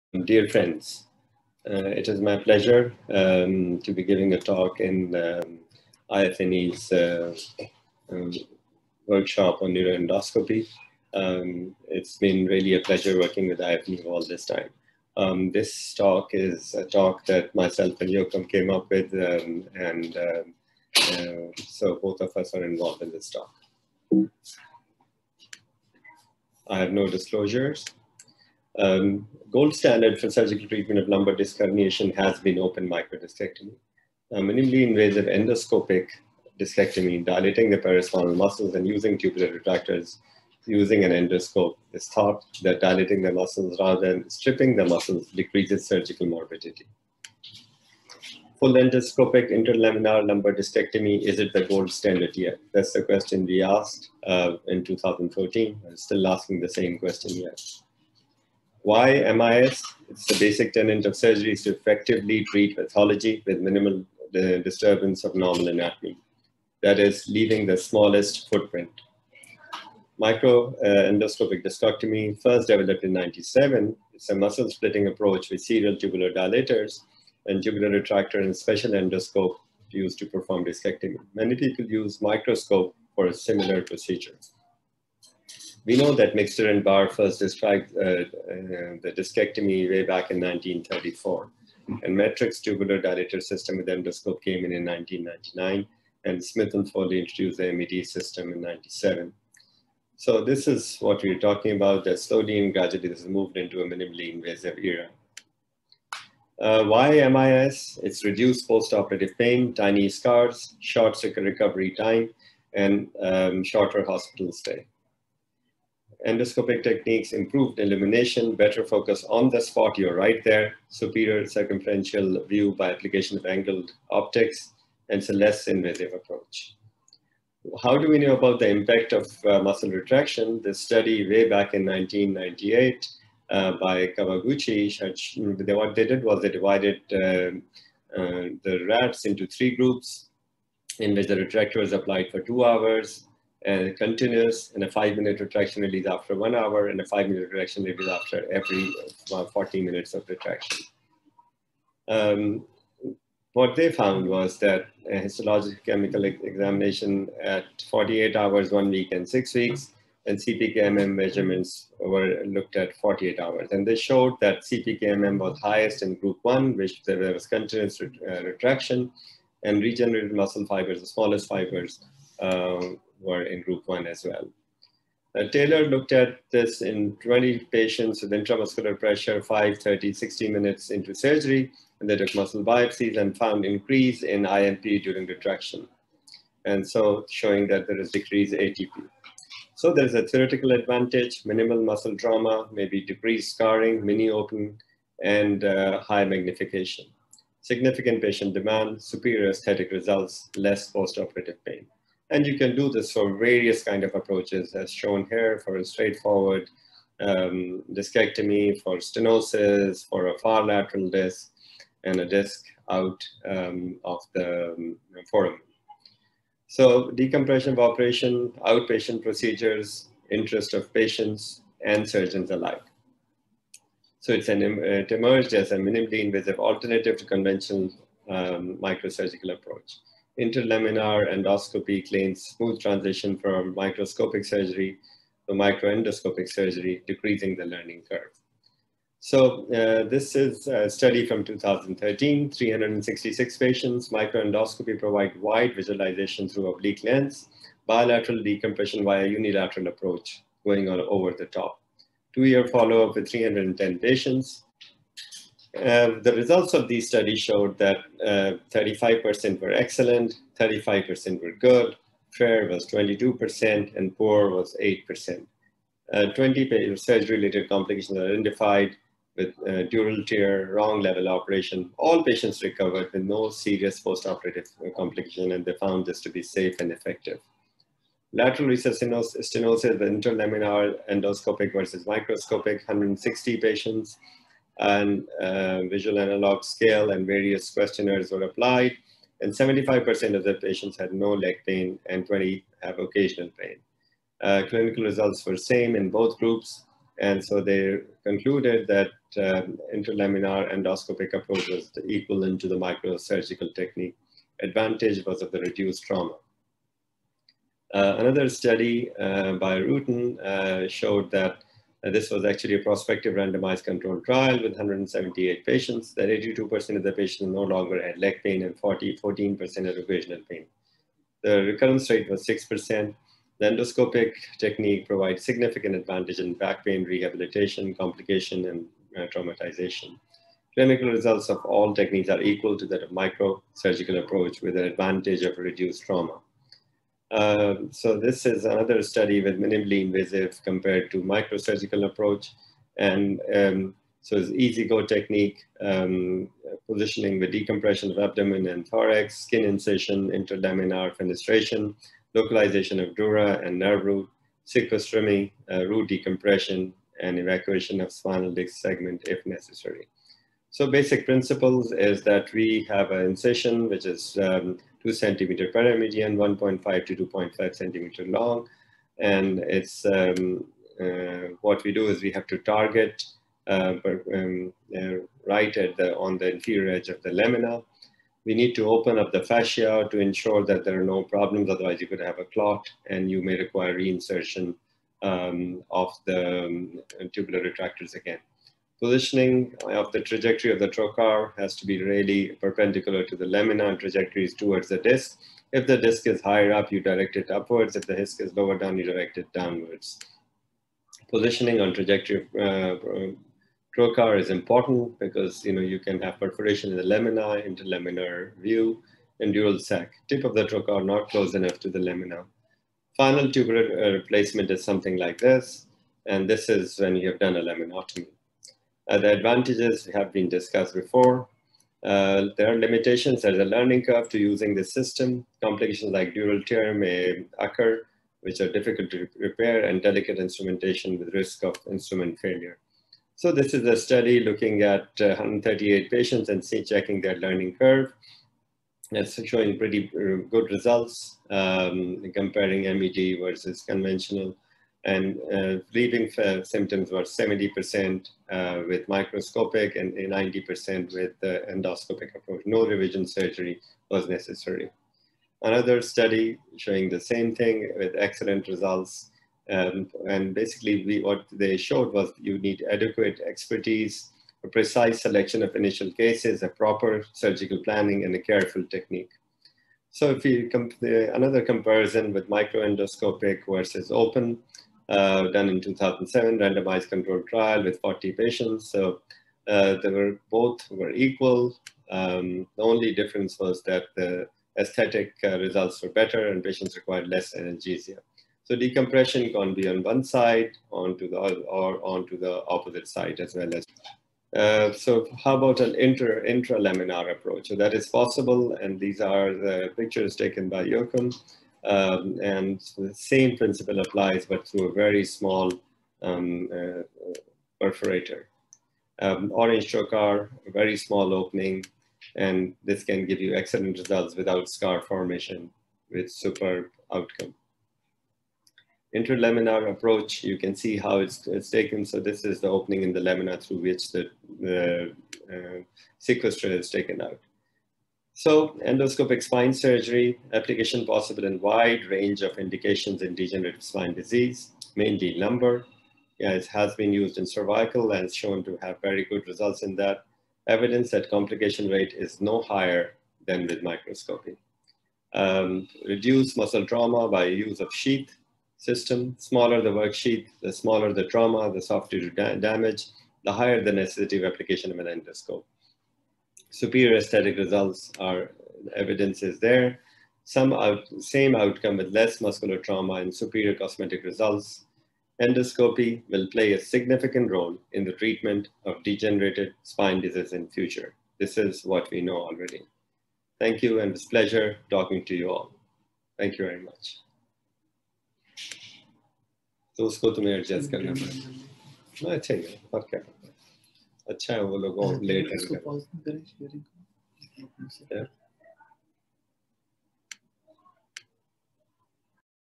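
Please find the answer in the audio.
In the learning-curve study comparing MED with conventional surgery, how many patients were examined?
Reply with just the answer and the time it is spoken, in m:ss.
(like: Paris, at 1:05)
138, at 7:15.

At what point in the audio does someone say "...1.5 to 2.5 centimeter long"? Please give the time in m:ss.
6:06.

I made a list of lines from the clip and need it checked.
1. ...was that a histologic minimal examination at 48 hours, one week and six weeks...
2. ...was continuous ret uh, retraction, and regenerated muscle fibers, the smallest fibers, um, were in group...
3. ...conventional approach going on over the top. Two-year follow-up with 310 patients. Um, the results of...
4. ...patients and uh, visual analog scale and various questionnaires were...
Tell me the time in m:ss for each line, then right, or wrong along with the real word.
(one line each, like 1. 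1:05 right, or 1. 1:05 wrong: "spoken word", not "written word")
1. 2:34 wrong: "chemical", not "minimal"
2. 2:47 right
3. 4:09 wrong: "unilateral", not "conventional"
4. 4:43 right.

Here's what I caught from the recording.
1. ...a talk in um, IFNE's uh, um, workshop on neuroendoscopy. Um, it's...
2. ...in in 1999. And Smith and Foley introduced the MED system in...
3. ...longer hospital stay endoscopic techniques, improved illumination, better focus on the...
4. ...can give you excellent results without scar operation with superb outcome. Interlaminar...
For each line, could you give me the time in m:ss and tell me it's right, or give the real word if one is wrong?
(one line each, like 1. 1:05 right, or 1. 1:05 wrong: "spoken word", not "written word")
1. 0:04 right
2. 1:34 right
3. 1:53 wrong: "shorter", not "longer"
4. 8:33 wrong: "formation", not "operation".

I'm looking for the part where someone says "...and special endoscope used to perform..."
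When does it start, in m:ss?
1:18.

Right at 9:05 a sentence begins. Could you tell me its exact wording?
Um, reduce muscle trauma by use of sheath system.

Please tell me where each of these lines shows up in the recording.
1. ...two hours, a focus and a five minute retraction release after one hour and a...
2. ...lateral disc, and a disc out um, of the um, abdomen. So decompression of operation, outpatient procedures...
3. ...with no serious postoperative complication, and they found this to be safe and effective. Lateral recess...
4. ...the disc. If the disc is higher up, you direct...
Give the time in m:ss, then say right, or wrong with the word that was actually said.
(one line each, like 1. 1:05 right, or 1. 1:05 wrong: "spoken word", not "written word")
1. 2:22 wrong: "continuous", not "focus"
2. 3:30 wrong: "foramen", not "abdomen"
3. 4:33 right
4. 6:34 right.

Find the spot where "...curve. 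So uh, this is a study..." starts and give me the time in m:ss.
3:58.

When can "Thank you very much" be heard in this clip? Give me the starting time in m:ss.
9:36.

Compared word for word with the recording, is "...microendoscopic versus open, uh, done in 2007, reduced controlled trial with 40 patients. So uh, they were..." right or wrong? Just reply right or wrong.
wrong.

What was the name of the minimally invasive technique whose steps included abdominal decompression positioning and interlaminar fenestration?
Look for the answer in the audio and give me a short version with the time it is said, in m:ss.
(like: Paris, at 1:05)
easyGO, at 5:44.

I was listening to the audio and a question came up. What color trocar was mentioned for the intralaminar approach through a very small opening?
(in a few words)
Orange.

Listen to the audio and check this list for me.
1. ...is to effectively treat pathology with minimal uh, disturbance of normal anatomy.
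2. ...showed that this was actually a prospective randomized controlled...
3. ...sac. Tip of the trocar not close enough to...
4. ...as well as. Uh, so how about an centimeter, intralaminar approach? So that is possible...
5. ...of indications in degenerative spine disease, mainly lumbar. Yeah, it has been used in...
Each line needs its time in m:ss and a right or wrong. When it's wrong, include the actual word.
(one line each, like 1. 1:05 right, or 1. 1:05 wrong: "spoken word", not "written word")
1. 1:01 right
2. 5:10 right
3. 6:49 right
4. 8:13 wrong: "inter", not "centimeter"
5. 8:52 right.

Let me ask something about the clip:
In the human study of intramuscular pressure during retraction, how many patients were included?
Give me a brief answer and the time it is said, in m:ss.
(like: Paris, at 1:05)
20, at 2:57.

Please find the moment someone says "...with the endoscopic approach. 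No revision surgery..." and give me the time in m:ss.
7:31.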